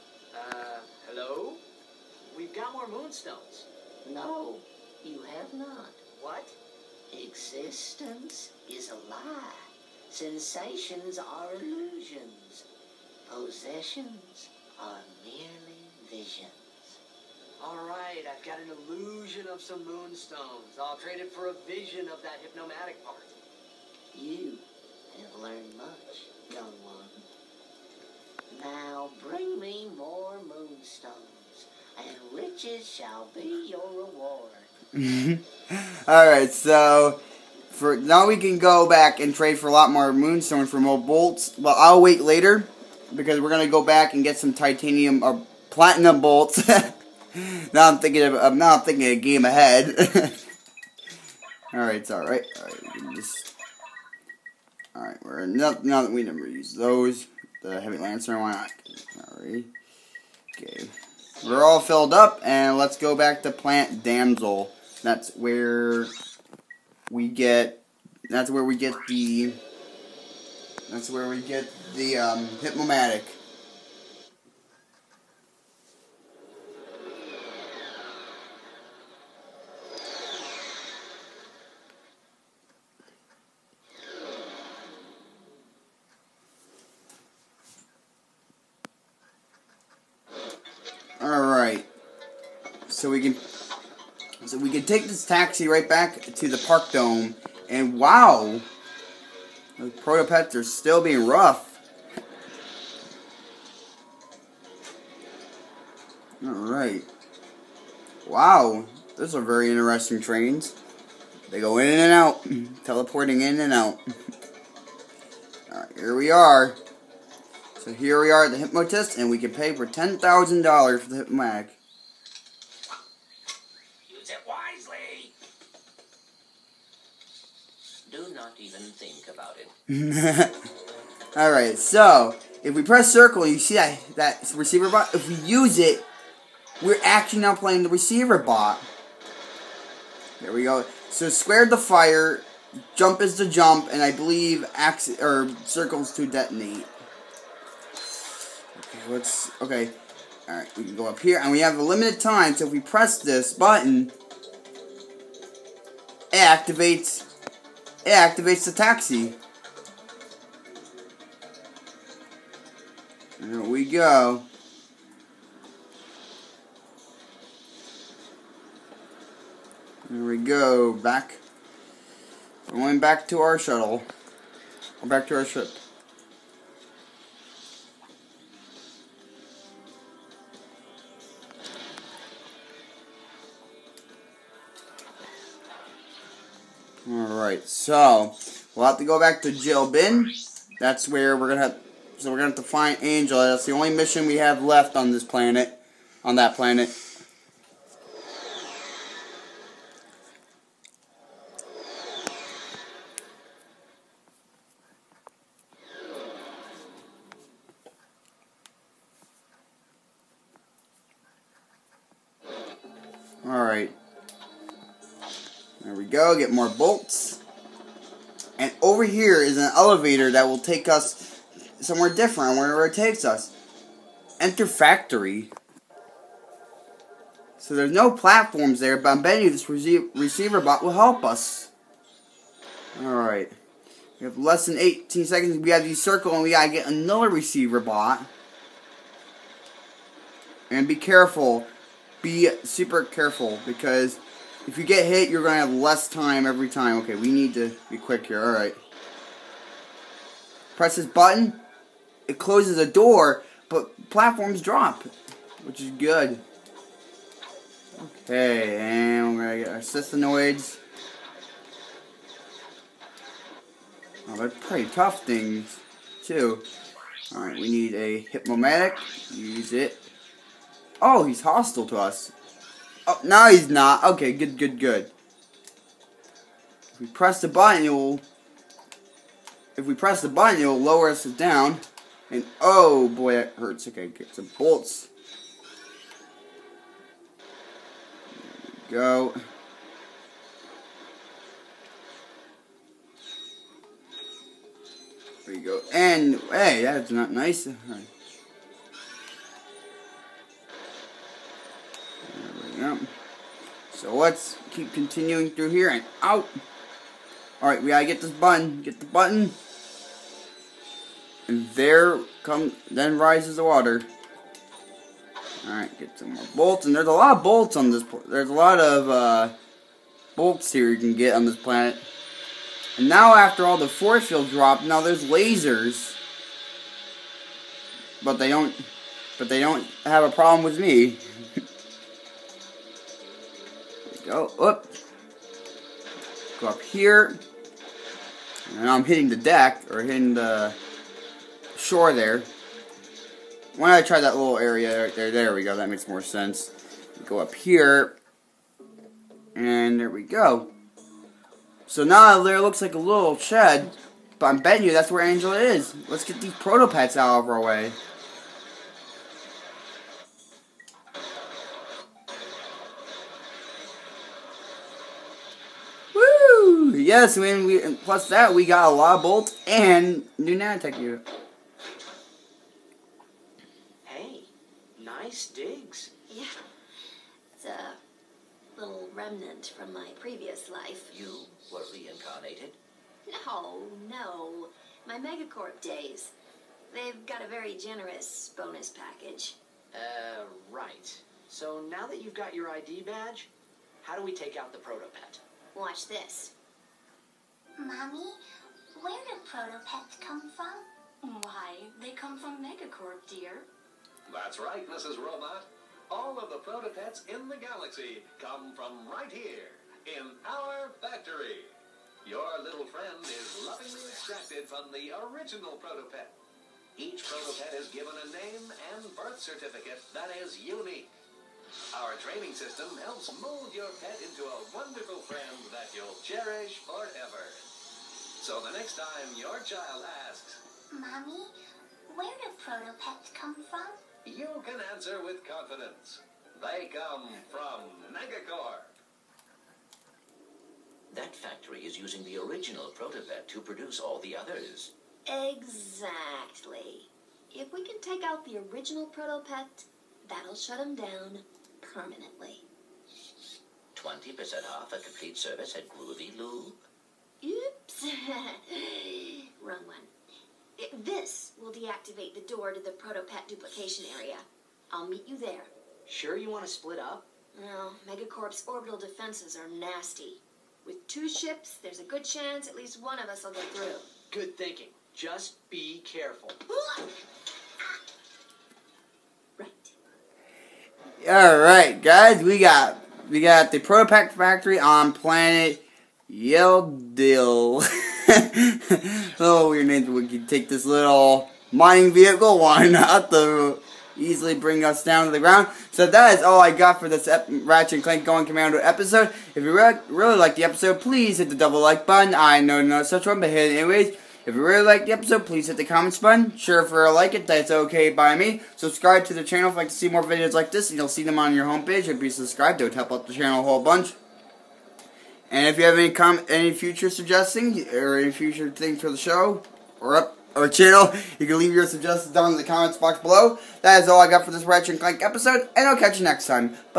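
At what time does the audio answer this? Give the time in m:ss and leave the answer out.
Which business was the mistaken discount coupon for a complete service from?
7:35.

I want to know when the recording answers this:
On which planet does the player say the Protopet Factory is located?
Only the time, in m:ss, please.
8:06.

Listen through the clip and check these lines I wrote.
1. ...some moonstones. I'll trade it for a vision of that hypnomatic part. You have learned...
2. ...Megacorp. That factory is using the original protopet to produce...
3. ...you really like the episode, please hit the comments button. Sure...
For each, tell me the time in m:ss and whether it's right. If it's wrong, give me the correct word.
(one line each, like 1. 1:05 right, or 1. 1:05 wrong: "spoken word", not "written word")
1. 0:19 right
2. 7:18 right
3. 8:24 right.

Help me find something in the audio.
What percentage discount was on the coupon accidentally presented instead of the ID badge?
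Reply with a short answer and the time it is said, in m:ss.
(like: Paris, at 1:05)
20%, at 7:33.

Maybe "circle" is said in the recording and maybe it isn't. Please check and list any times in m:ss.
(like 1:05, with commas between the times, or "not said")
2:13, 2:25, 3:55.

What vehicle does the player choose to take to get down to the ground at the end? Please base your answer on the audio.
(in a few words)
mining vehicle.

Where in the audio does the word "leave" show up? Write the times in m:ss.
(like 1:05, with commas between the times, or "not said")
8:41.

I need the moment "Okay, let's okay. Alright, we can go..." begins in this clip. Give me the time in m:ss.
2:28.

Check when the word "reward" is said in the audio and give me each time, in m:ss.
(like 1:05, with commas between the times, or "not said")
0:33.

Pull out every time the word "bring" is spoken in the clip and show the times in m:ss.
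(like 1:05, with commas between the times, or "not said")
0:29, 8:14.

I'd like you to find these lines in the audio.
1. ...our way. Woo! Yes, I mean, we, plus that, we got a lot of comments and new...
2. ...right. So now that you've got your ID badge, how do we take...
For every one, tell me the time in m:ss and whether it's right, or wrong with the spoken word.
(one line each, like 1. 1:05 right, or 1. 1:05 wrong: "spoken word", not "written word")
1. 5:57 wrong: "bolts", not "comments"
2. 6:30 right.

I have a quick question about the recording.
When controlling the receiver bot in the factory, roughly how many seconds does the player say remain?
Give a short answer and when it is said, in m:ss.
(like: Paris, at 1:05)
18, at 3:54.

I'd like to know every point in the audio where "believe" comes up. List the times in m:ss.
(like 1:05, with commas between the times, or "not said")
2:24.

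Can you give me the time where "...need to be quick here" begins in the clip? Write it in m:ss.
4:07.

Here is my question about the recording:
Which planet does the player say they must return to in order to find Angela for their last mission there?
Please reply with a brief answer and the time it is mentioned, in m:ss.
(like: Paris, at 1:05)
Grelbin, at 3:09.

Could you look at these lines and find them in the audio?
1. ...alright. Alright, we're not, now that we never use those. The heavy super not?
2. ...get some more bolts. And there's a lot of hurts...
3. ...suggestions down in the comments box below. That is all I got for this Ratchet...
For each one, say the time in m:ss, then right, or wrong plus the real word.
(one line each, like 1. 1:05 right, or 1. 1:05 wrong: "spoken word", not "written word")
1. 0:52 wrong: "lancer", not "super"
2. 5:15 wrong: "bolts", not "hurts"
3. 8:41 right.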